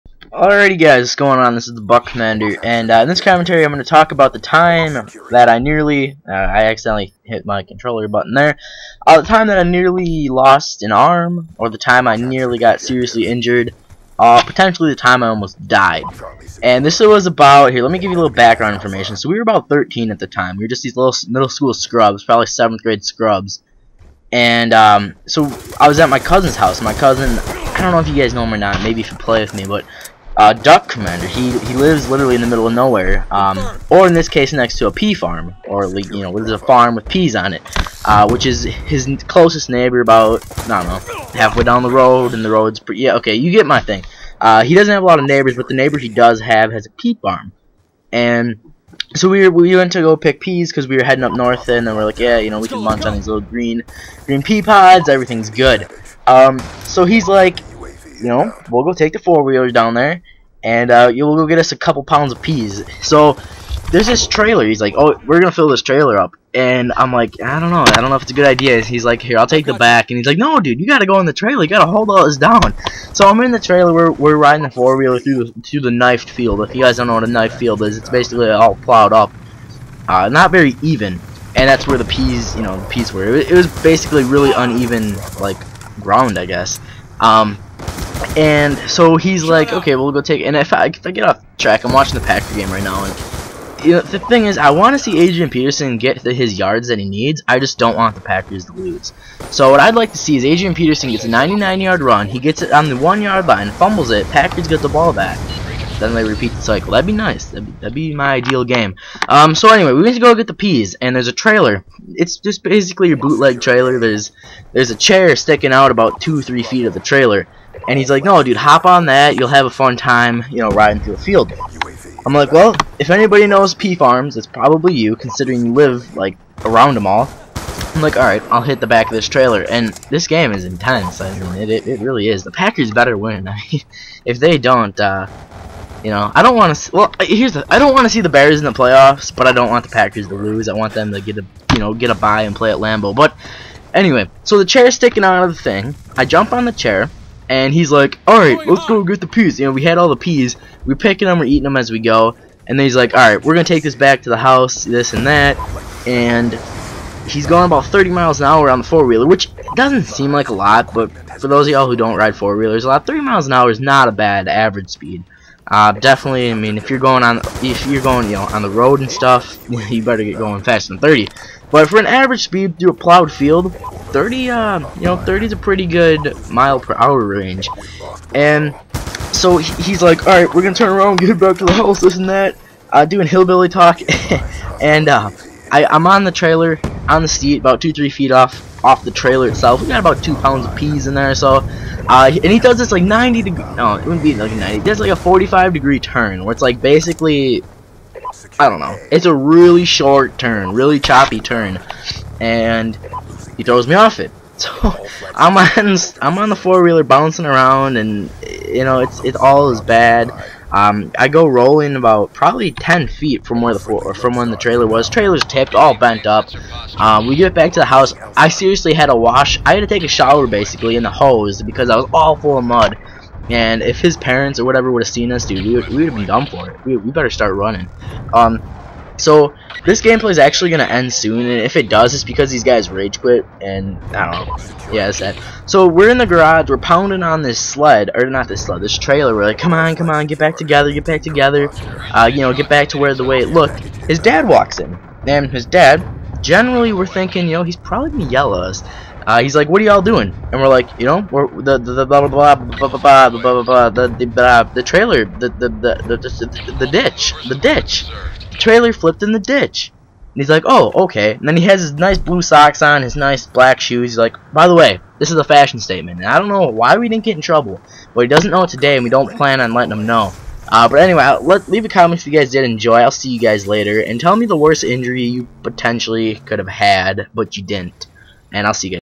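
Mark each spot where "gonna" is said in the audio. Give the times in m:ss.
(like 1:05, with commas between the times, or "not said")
1:05, 3:00, 3:50, 4:08.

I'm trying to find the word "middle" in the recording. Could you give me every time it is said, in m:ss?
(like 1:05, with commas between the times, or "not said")
0:21, 0:32.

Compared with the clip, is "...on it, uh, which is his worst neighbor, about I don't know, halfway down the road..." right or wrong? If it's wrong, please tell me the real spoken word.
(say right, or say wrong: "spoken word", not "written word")
wrong: "closest", not "worst".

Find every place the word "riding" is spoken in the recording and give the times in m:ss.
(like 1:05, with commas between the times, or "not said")
1:14, 2:00.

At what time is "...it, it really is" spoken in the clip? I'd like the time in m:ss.
2:11.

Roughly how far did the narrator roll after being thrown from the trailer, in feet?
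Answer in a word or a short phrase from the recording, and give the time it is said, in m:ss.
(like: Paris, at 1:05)
10 feet, at 3:32.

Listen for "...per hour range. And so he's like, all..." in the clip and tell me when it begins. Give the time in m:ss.
2:56.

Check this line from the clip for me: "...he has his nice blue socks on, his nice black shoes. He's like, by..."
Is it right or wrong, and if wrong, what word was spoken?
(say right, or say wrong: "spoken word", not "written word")
right.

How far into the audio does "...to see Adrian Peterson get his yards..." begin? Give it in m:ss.
1:34.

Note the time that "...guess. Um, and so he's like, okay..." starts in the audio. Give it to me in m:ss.
1:26.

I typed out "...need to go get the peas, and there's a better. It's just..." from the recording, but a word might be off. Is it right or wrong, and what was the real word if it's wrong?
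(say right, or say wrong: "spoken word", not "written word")
wrong: "trailer", not "better".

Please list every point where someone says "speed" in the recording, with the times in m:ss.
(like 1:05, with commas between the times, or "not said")
2:44, 2:52.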